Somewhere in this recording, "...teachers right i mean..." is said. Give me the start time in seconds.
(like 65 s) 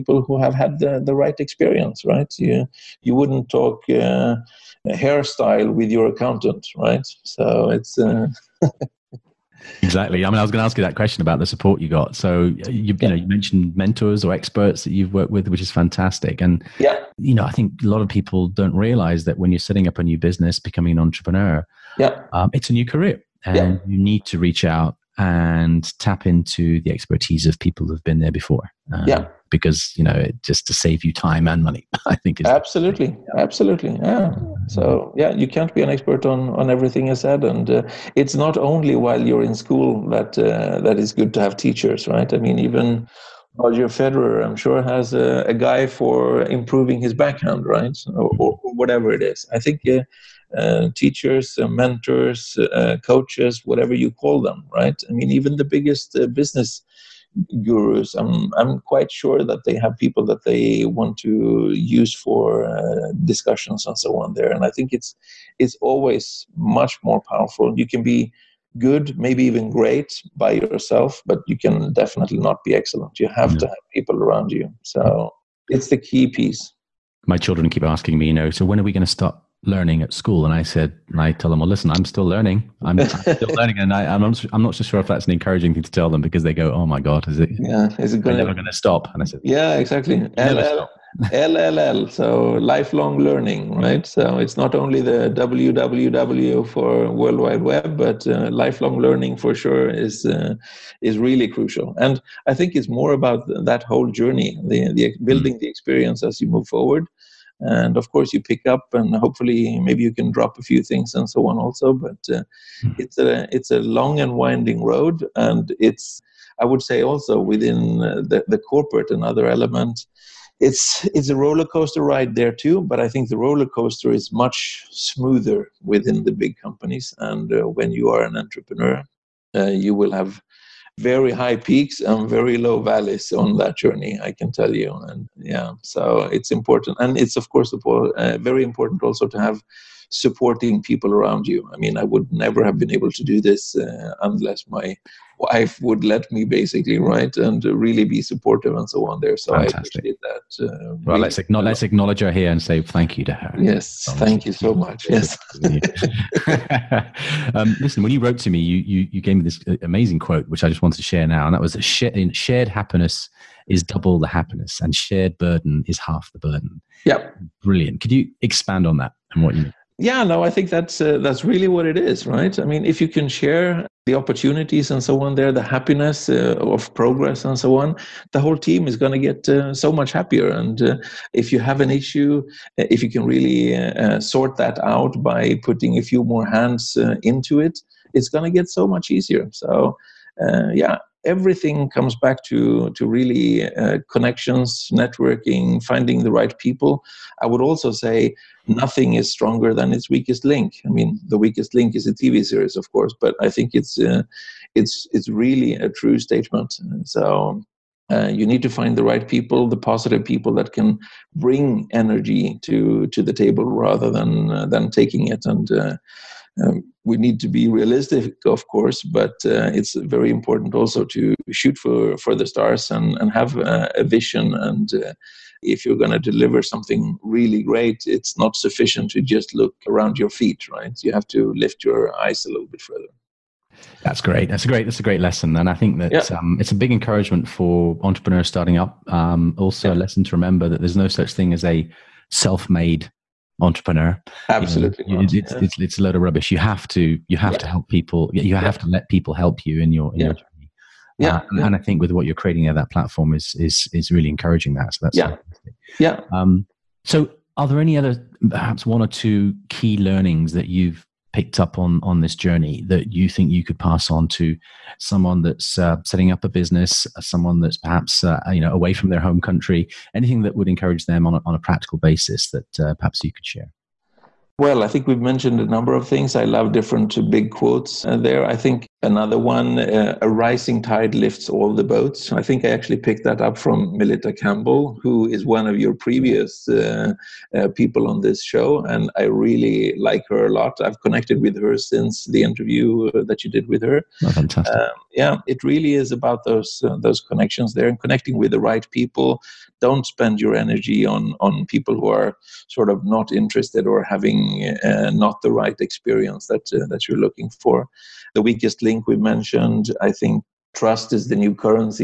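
41 s.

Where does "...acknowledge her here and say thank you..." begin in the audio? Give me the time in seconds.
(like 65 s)
151 s.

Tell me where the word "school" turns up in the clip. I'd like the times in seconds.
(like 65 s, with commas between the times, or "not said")
39 s, 80 s.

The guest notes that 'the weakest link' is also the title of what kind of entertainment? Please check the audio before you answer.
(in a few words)
TV series.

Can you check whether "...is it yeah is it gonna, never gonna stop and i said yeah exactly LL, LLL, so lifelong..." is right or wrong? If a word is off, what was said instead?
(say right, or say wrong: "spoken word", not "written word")
right.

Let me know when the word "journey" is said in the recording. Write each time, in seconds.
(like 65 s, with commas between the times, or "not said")
104 s, 133 s, 250 s, 262 s.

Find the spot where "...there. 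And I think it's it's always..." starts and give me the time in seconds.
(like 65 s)
64 s.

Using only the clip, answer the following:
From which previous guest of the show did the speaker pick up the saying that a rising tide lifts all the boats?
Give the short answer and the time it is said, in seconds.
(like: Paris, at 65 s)
Melita Campbell, at 283 s.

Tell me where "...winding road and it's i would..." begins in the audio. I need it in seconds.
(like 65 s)
114 s.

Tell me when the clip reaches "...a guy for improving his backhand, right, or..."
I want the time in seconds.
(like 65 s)
45 s.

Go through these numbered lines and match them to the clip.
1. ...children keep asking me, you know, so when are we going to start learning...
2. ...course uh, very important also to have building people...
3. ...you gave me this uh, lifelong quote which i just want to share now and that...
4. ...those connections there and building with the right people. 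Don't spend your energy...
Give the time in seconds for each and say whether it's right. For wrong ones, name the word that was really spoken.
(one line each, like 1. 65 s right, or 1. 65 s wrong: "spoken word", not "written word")
1. 77 s right
2. 137 s wrong: "supporting", not "building"
3. 159 s wrong: "amazing", not "lifelong"
4. 296 s wrong: "connecting", not "building".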